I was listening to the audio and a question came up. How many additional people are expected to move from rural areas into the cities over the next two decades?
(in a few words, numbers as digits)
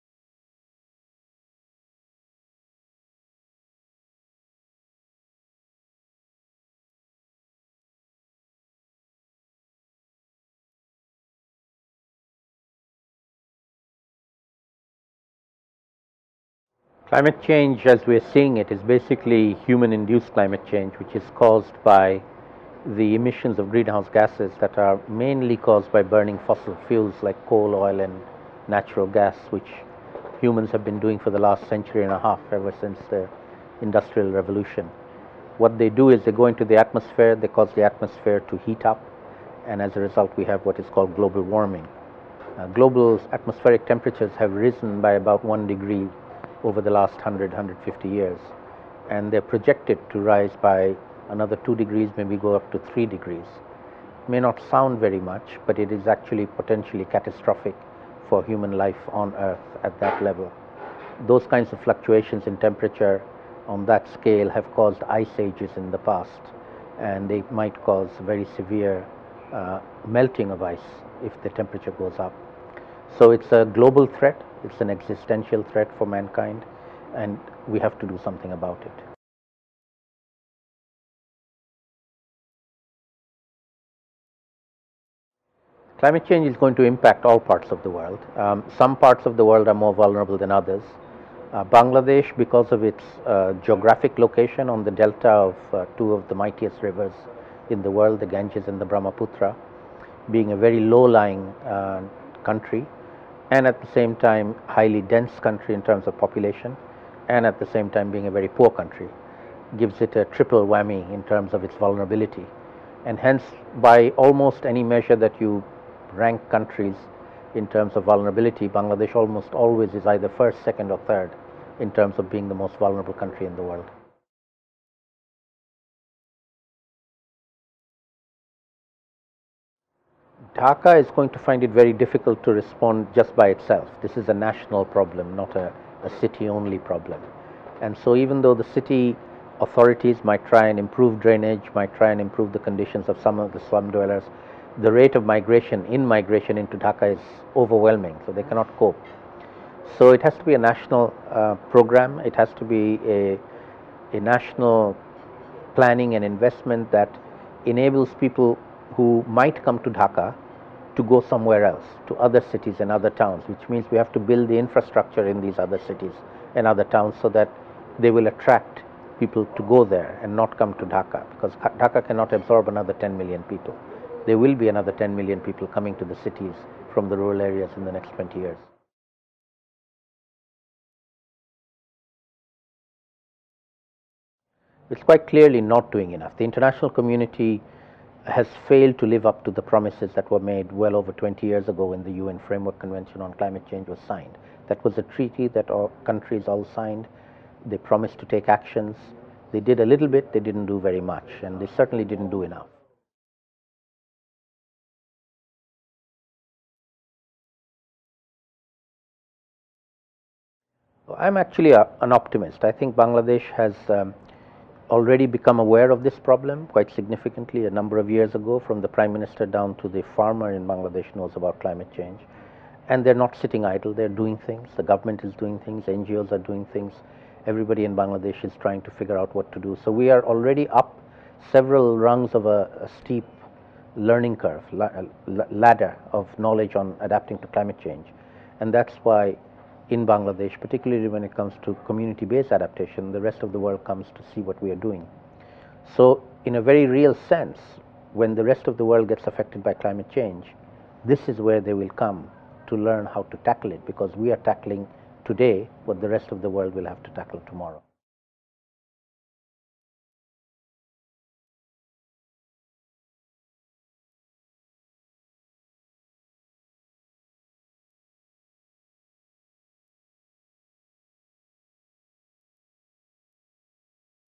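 10 million.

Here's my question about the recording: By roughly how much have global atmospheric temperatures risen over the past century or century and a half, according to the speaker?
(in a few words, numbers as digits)
1 degree.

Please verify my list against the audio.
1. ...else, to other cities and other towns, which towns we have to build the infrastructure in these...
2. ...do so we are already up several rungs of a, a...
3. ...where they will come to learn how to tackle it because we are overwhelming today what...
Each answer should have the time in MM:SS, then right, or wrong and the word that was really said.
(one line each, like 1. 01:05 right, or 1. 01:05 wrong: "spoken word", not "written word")
1. 02:41 wrong: "means", not "towns"
2. 03:49 right
3. 04:11 wrong: "tackling", not "overwhelming".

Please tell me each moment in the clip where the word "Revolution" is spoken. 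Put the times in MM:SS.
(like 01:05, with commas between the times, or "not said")
00:34.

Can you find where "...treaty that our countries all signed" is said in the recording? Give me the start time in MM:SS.
03:15.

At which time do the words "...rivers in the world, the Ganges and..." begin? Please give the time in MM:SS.
01:36.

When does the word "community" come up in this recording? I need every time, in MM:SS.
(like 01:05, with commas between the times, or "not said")
03:06, 04:01.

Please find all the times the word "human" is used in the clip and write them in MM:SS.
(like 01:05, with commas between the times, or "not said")
00:19, 00:30, 00:58.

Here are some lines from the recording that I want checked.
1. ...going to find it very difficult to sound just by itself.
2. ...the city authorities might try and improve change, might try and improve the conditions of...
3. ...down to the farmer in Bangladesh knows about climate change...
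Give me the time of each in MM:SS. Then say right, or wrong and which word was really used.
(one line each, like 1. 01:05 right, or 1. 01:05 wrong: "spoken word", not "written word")
1. 02:11 wrong: "respond", not "sound"
2. 02:18 wrong: "drainage", not "change"
3. 03:39 right.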